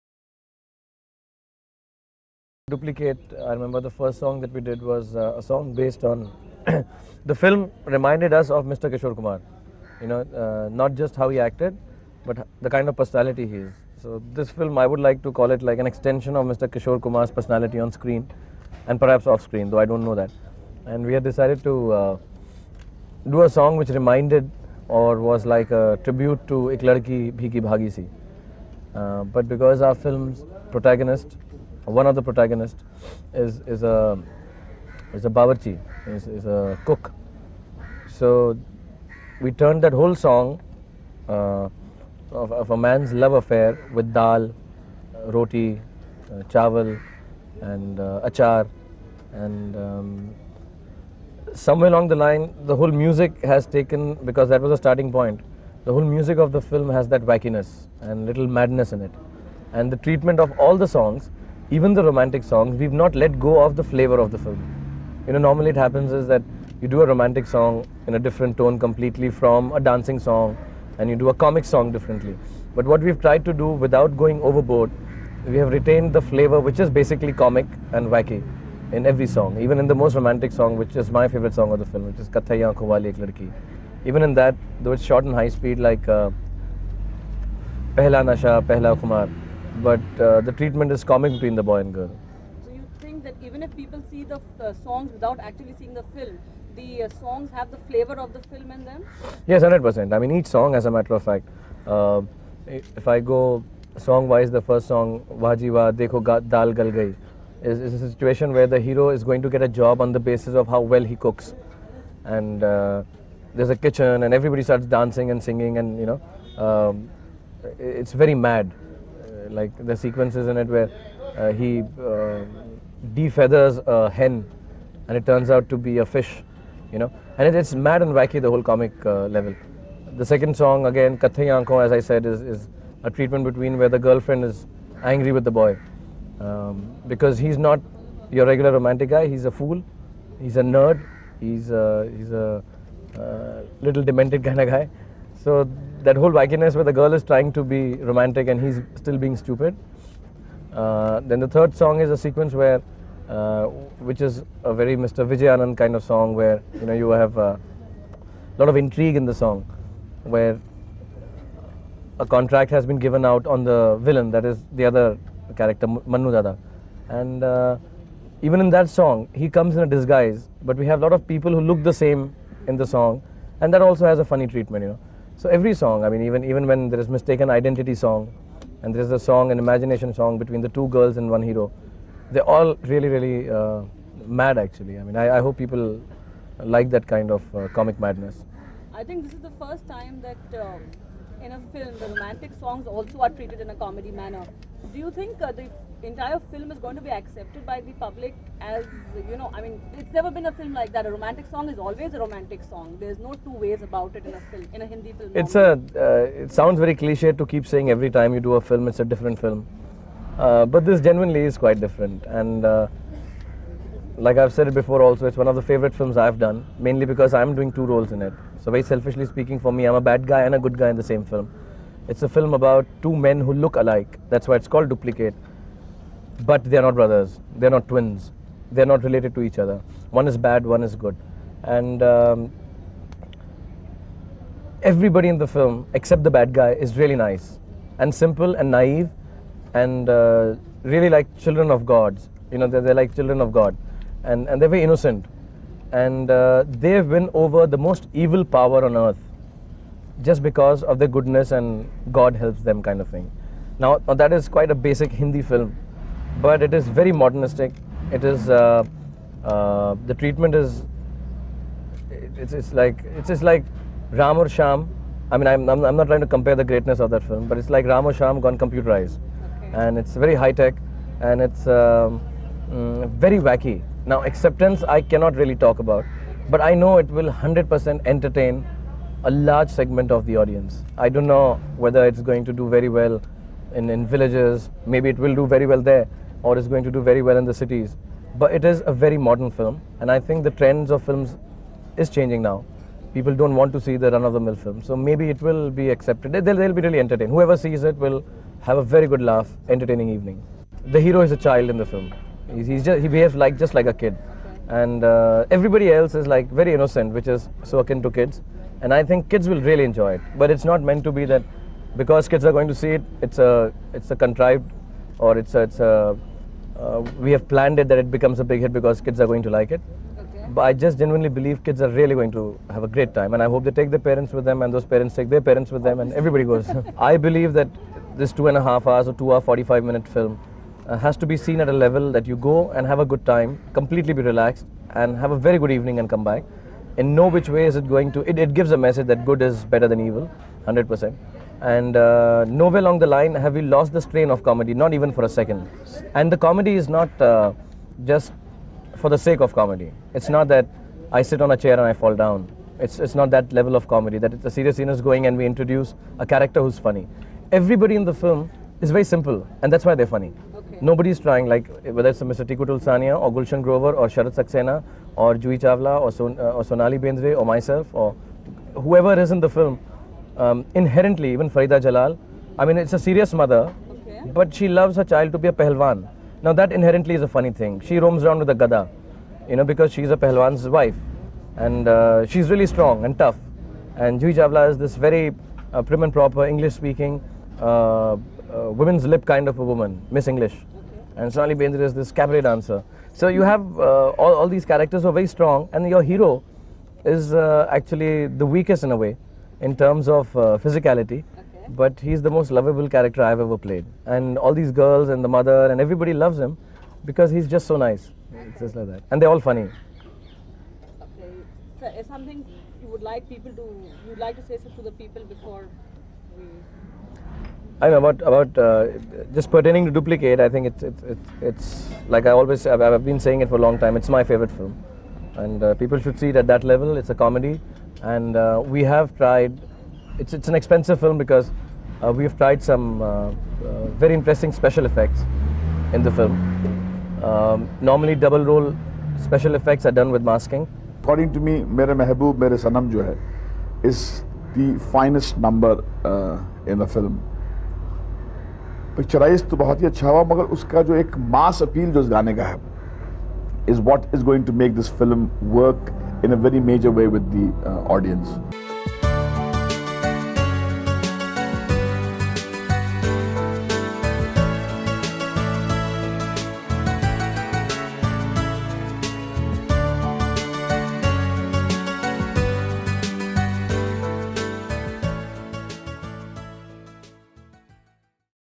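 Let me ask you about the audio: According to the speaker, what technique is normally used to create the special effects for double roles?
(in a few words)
Masking.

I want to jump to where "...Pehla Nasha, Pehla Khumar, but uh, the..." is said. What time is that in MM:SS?
01:27.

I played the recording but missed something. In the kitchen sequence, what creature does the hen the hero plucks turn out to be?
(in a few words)
Fish.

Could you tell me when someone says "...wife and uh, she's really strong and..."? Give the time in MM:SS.
06:20.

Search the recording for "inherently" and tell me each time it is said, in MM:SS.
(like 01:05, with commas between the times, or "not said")
06:10, 06:16.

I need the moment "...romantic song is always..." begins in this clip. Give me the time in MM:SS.
03:21.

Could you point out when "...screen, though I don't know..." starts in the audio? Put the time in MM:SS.
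00:19.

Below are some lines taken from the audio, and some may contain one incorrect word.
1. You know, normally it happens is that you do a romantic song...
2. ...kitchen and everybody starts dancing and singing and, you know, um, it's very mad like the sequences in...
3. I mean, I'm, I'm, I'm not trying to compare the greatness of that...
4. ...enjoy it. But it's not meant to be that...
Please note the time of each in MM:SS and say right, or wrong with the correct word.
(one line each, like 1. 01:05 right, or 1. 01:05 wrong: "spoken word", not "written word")
1. 01:05 right
2. 01:53 right
3. 04:25 right
4. 05:09 right.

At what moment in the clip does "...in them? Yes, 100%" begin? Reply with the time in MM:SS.
01:38.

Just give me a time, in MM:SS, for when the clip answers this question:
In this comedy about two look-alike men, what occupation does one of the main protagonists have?
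00:36.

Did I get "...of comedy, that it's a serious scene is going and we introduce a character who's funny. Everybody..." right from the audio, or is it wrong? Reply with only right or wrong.
right.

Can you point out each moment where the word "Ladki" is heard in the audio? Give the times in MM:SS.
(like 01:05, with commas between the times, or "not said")
00:26, 01:23.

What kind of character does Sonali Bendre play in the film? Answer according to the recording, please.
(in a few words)
Cabaret dancer.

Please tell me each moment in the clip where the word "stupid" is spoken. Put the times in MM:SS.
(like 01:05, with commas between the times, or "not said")
02:29.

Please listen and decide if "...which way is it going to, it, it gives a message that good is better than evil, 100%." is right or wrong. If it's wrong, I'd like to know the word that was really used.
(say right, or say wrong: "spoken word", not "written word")
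right.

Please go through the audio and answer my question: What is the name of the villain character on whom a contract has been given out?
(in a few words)
Manu Dada.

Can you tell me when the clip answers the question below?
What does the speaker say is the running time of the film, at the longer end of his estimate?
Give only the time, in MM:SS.
05:29.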